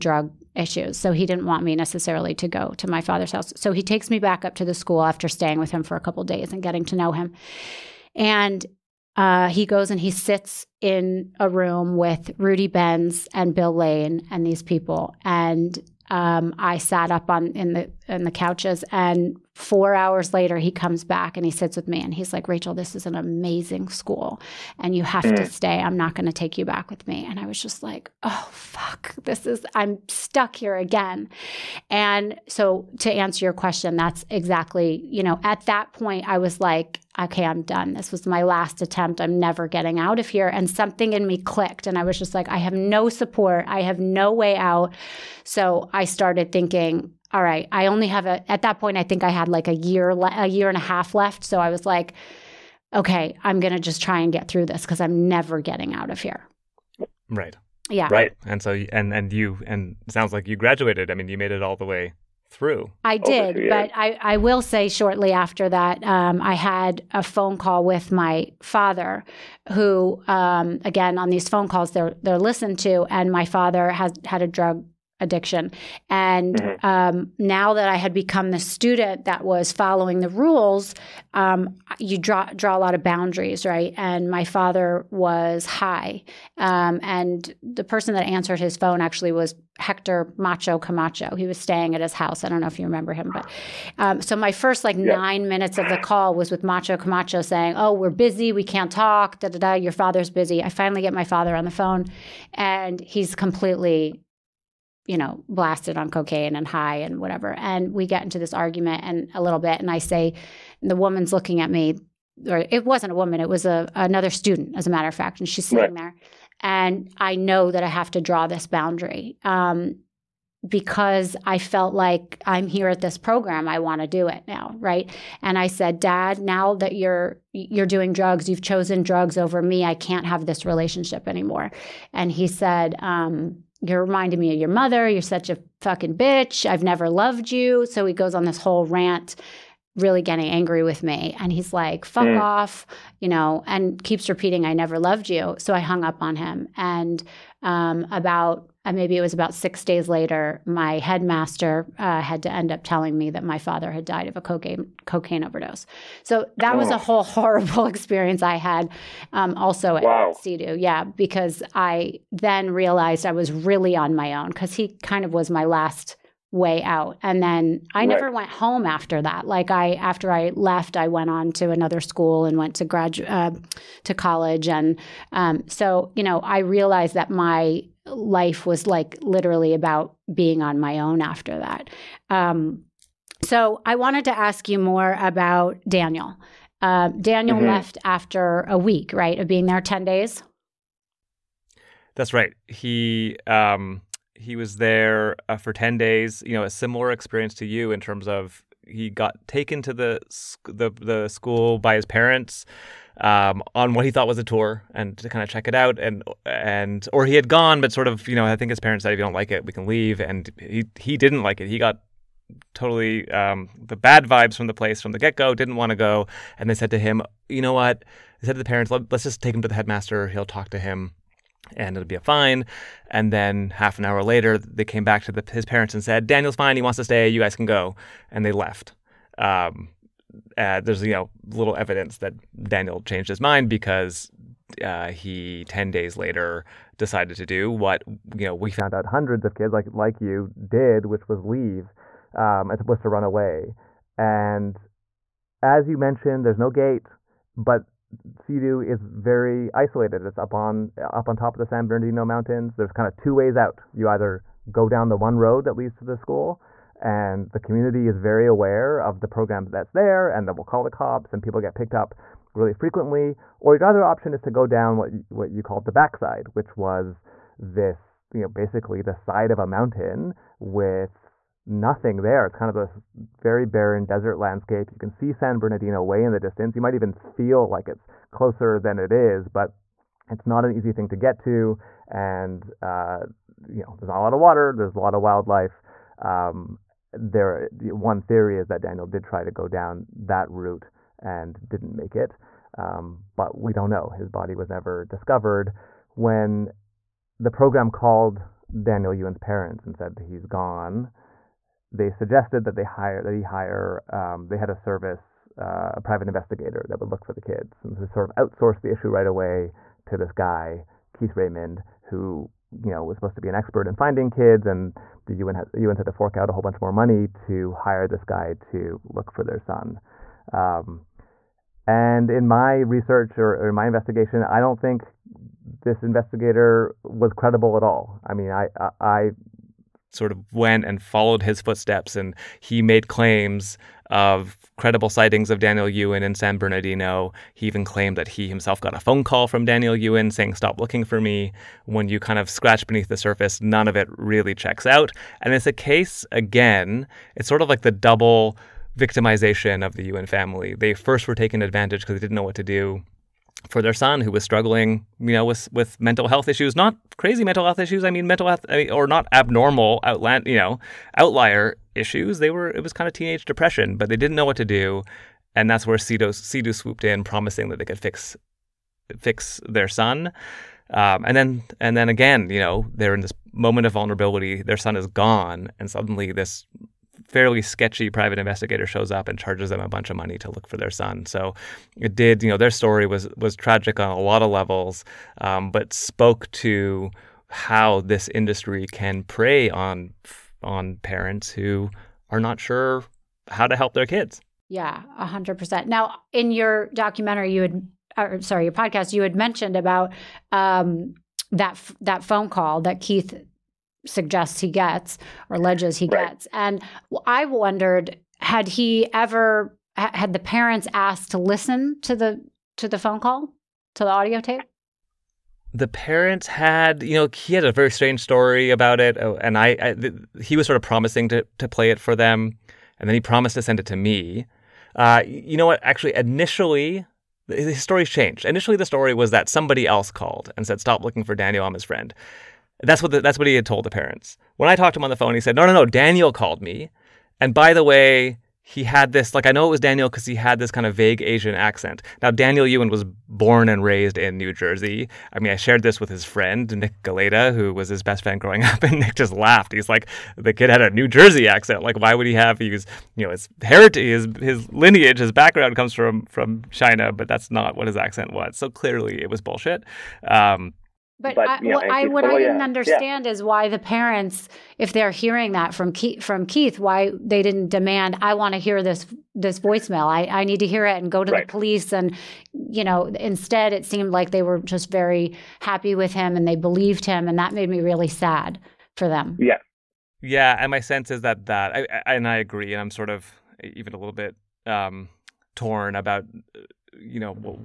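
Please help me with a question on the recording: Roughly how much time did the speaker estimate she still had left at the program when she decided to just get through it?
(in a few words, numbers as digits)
a year and a half.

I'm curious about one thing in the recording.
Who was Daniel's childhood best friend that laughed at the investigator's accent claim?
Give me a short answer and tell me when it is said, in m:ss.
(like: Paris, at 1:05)
Nick Galeta, at 7:26.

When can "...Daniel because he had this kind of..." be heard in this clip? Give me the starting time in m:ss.
7:19.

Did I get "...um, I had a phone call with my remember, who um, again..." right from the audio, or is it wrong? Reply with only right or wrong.
wrong.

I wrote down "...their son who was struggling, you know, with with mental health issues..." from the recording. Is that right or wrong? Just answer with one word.
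right.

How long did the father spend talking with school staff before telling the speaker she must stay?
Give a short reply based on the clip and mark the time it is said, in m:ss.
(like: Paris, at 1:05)
4 hours, at 0:19.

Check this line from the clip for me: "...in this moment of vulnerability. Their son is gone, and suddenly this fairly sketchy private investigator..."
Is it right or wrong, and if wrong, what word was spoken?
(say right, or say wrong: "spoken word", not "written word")
right.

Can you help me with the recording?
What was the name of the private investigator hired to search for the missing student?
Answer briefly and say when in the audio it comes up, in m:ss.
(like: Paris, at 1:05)
Keith Raymond, at 5:11.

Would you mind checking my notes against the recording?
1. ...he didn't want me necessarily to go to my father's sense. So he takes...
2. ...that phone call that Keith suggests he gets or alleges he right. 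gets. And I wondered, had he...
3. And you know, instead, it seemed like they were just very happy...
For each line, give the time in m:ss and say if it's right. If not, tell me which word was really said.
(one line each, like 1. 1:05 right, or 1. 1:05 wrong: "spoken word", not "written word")
1. 0:01 wrong: "house", not "sense"
2. 6:42 right
3. 7:51 right.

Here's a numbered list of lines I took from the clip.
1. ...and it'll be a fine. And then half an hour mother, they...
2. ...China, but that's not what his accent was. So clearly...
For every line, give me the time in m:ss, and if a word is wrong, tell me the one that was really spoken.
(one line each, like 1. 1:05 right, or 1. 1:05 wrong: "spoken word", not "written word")
1. 3:41 wrong: "later", not "mother"
2. 7:36 right.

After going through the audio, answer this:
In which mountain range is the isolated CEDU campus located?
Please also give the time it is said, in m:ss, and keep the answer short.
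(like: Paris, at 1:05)
San Bernardino Mountains, at 4:11.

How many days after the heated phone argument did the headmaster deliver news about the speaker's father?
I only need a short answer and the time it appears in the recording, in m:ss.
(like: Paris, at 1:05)
6, at 2:29.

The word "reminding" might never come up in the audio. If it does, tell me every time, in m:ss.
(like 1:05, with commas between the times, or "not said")
2:14.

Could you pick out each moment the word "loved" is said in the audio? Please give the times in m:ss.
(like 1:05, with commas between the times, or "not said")
2:17, 2:24.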